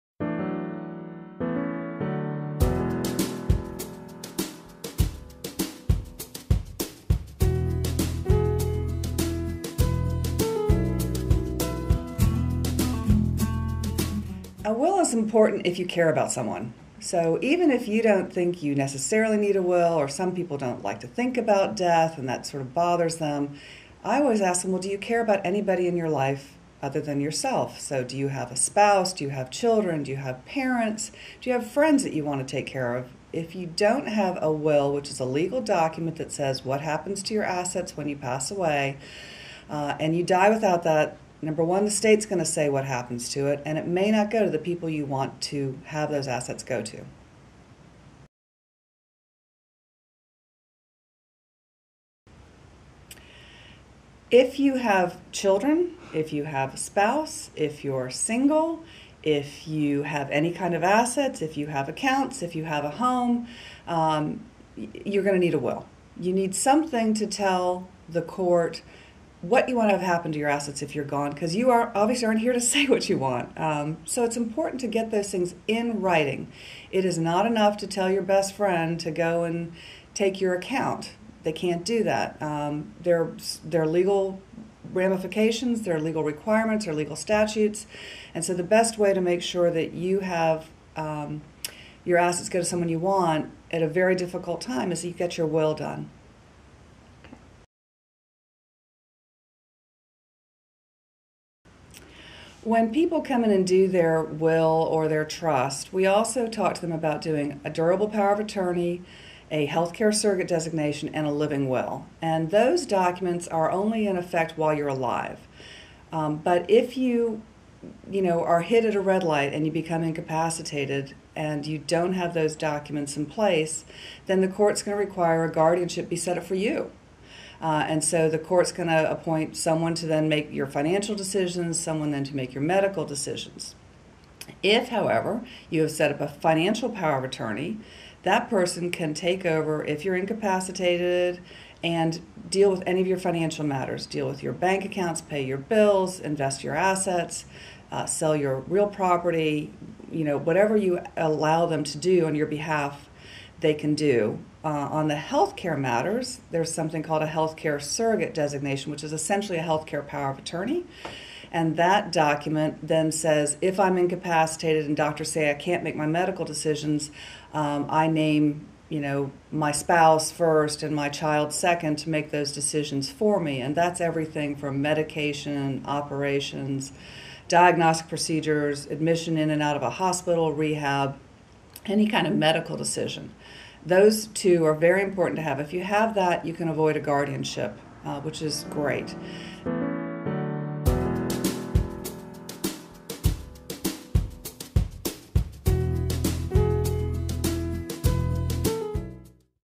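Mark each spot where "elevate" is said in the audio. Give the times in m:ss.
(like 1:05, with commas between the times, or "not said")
not said.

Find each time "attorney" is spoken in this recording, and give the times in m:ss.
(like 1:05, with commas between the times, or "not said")
1:48, 2:17, 2:40.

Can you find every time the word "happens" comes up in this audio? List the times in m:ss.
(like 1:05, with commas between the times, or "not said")
0:36, 0:42, 1:10.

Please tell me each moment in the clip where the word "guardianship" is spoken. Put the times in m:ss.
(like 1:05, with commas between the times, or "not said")
2:05, 3:06.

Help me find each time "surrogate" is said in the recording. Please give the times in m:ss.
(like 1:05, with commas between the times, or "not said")
1:50, 2:37.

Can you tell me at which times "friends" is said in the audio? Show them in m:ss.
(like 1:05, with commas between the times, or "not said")
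0:31, 1:18.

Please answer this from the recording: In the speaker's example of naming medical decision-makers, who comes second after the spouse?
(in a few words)
My child.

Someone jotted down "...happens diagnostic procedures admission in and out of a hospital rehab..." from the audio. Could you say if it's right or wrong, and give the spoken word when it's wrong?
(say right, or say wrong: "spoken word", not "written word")
wrong: "operations", not "happens".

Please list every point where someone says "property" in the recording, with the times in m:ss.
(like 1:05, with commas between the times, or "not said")
2:28.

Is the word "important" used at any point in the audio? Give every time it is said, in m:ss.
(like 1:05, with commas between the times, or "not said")
0:15, 1:14, 3:05.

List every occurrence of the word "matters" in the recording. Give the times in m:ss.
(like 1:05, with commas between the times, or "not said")
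2:23, 2:35.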